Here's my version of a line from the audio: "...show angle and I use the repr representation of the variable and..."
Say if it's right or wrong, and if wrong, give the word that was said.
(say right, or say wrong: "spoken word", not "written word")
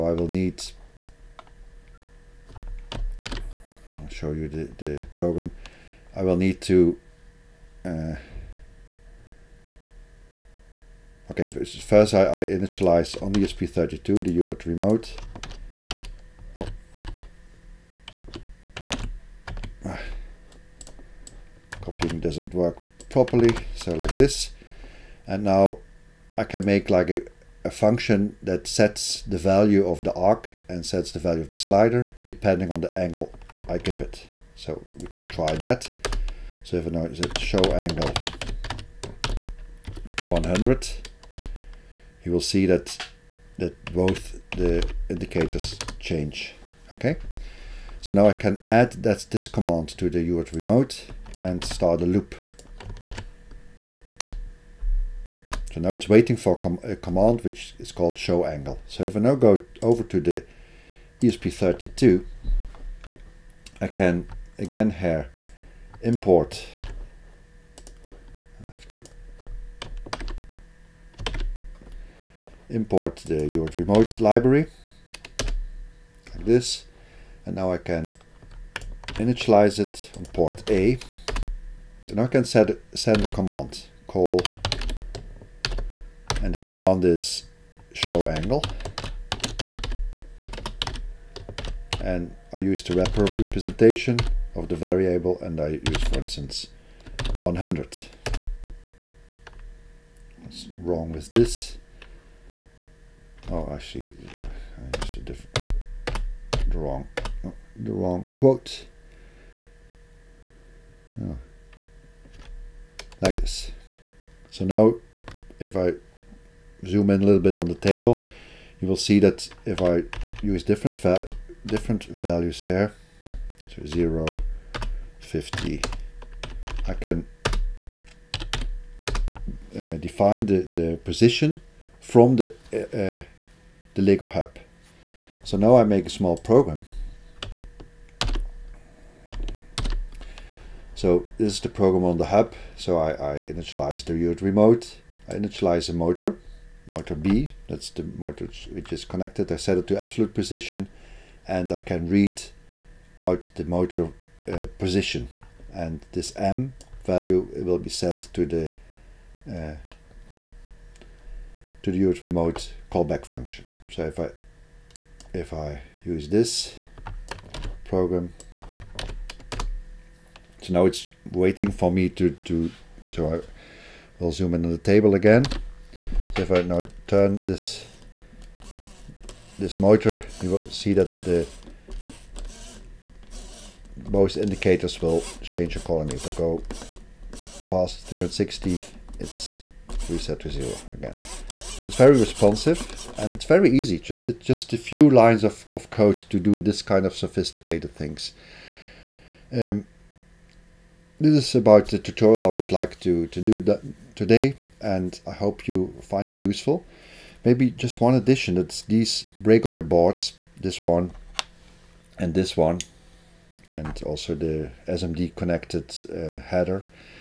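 right.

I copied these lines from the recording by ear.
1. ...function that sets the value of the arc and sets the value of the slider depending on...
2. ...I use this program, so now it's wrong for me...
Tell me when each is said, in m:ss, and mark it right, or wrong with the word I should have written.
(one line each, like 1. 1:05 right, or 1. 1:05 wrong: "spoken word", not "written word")
1. 0:27 right
2. 2:45 wrong: "waiting", not "wrong".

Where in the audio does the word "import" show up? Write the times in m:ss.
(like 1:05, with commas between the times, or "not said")
1:06, 1:12.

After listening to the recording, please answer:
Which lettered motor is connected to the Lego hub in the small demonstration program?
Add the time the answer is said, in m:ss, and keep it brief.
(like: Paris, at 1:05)
motor B, at 2:26.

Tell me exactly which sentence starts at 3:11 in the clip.
It's very responsive and it's very easy.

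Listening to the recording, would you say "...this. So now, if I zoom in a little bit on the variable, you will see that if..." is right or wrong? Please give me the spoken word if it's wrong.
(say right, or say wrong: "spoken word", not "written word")
wrong: "table", not "variable".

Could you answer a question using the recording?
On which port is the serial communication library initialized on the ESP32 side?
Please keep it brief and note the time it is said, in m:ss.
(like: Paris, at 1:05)
port A, at 1:20.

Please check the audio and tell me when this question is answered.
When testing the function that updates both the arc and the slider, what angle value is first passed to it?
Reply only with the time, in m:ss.
0:37.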